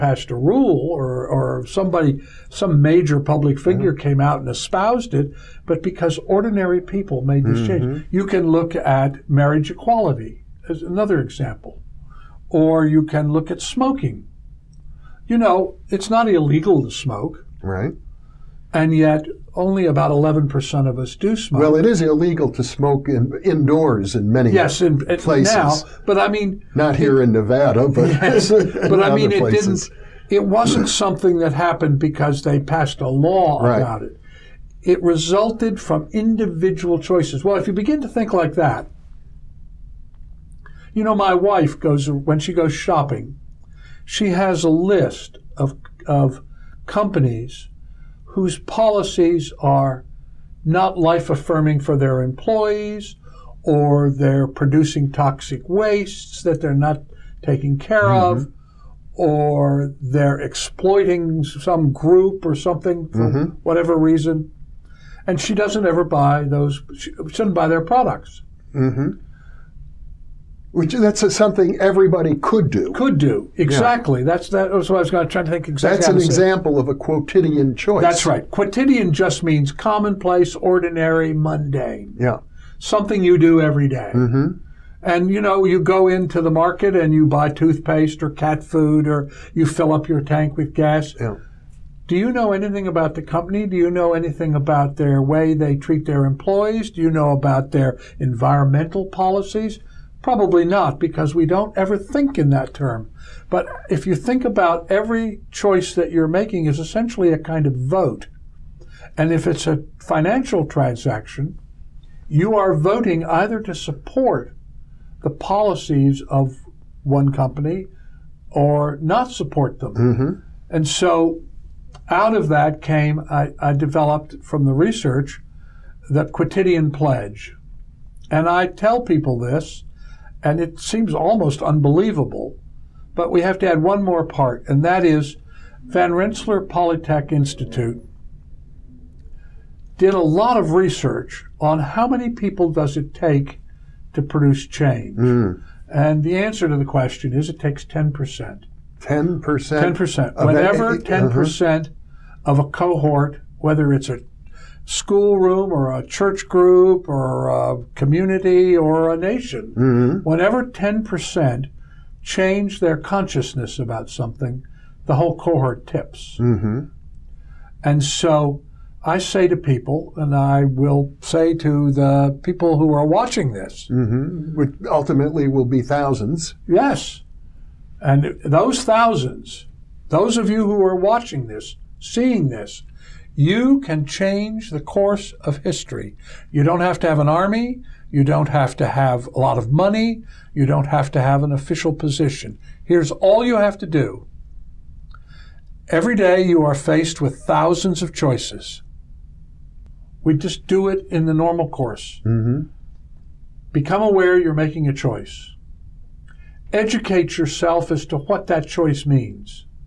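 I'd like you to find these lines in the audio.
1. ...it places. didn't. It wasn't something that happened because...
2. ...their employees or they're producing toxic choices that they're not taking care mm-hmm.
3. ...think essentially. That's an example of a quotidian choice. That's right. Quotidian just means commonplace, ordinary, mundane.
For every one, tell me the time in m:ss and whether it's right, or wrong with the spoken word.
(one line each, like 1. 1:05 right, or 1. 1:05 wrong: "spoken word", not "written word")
1. 0:29 right
2. 0:51 wrong: "wastes", not "choices"
3. 1:15 wrong: "exactly", not "essentially".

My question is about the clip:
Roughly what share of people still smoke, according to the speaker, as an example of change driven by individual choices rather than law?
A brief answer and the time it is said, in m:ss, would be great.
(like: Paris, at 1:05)
11%, at 0:20.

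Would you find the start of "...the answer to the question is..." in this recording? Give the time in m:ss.
2:26.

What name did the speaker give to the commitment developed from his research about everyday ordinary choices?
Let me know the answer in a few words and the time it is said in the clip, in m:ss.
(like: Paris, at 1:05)
quotidian pledge, at 2:06.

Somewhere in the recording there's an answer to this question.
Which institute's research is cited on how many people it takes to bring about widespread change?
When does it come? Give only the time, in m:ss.
2:15.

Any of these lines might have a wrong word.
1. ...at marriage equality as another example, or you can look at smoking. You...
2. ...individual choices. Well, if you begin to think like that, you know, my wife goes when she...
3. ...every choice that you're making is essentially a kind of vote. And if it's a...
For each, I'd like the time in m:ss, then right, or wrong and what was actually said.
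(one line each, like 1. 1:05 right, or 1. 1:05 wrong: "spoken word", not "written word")
1. 0:08 right
2. 0:36 right
3. 1:44 right.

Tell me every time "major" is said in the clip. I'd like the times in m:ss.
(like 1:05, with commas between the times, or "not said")
0:02.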